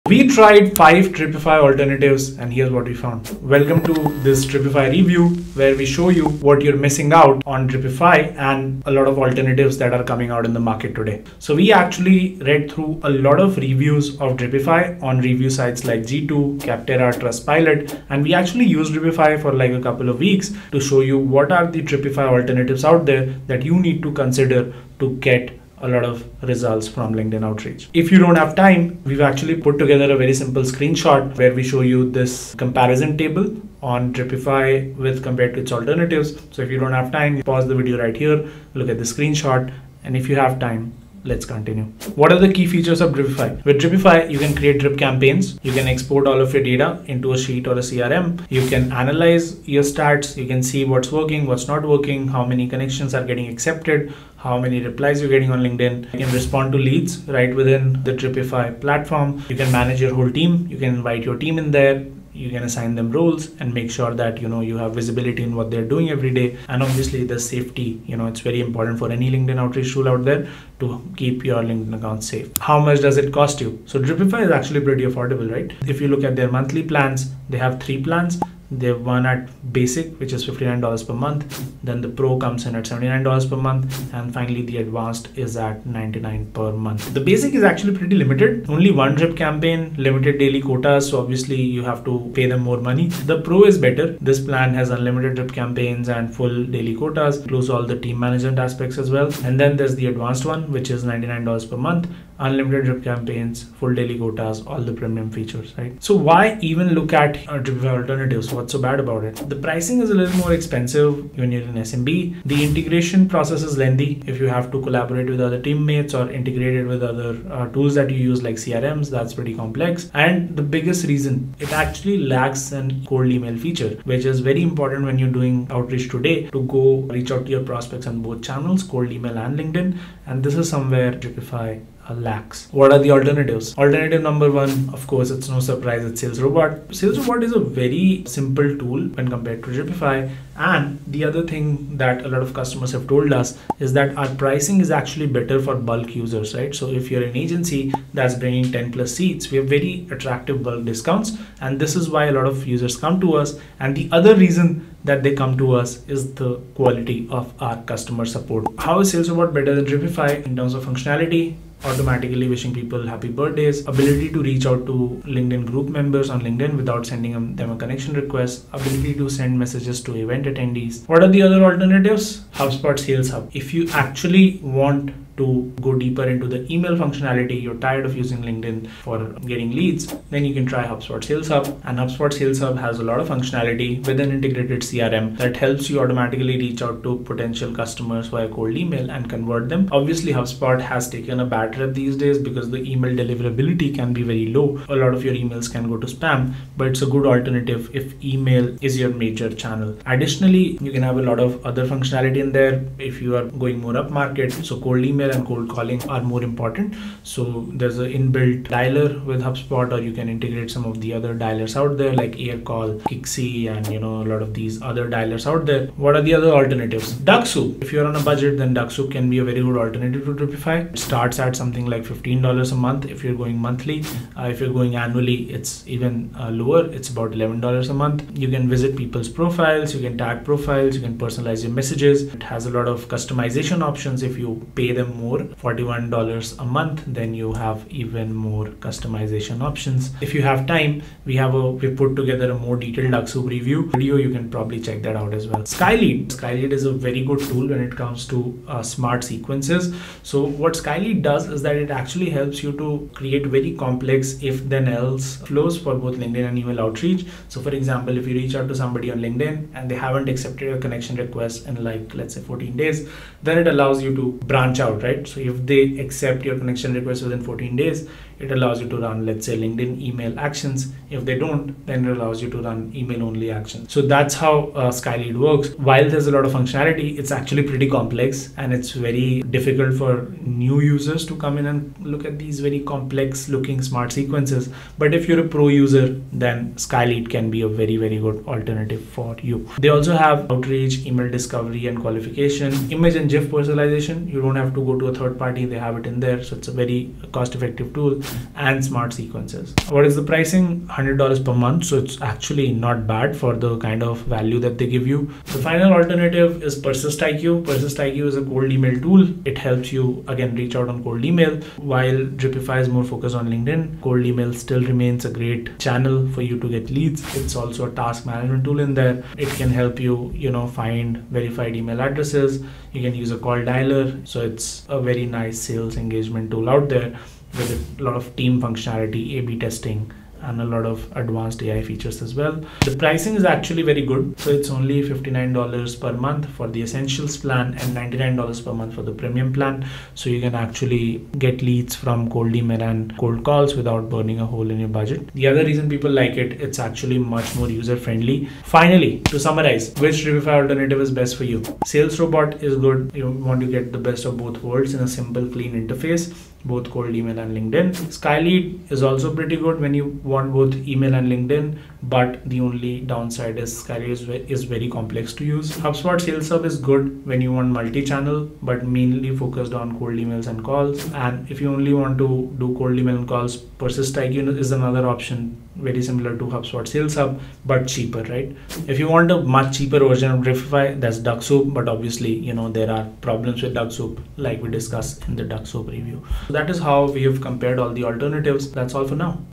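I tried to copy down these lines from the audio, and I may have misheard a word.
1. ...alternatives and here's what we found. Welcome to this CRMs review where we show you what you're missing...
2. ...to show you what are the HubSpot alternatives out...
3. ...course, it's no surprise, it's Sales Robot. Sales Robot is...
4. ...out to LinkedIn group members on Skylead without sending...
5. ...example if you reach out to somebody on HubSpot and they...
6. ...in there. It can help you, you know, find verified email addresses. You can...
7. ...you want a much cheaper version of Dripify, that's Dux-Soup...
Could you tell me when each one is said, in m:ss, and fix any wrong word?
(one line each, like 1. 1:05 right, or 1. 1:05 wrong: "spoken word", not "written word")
1. 0:01 wrong: "Dripify", not "CRMs"
2. 0:20 wrong: "Dripify", not "HubSpot"
3. 2:15 right
4. 2:44 wrong: "LinkedIn", not "Skylead"
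5. 4:17 wrong: "LinkedIn", not "HubSpot"
6. 5:18 right
7. 6:18 right.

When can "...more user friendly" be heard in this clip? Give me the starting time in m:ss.
5:47.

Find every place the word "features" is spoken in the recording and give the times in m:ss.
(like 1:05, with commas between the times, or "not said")
0:42, 1:45, 2:03, 5:31.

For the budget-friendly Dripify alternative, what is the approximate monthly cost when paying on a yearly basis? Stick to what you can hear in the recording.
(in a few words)
$11.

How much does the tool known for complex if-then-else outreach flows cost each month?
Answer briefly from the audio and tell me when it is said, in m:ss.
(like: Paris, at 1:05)
$100, at 5:00.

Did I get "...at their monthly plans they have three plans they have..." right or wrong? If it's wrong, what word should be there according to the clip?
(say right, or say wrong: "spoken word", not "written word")
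right.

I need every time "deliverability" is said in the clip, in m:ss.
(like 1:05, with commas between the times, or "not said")
3:13.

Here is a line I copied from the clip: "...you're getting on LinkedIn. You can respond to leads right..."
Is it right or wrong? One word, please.
right.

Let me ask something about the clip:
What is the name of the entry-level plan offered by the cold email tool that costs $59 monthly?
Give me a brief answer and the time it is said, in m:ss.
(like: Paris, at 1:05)
Essentials, at 5:36.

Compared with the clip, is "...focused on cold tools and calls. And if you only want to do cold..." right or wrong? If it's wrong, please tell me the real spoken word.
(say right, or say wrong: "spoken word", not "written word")
wrong: "emails", not "tools".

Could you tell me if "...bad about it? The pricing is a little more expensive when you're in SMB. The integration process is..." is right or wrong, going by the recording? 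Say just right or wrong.
right.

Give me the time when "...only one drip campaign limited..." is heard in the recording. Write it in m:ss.
1:28.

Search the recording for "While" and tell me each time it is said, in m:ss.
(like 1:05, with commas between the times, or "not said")
4:35, 5:11.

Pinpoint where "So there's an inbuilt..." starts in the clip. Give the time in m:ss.
3:27.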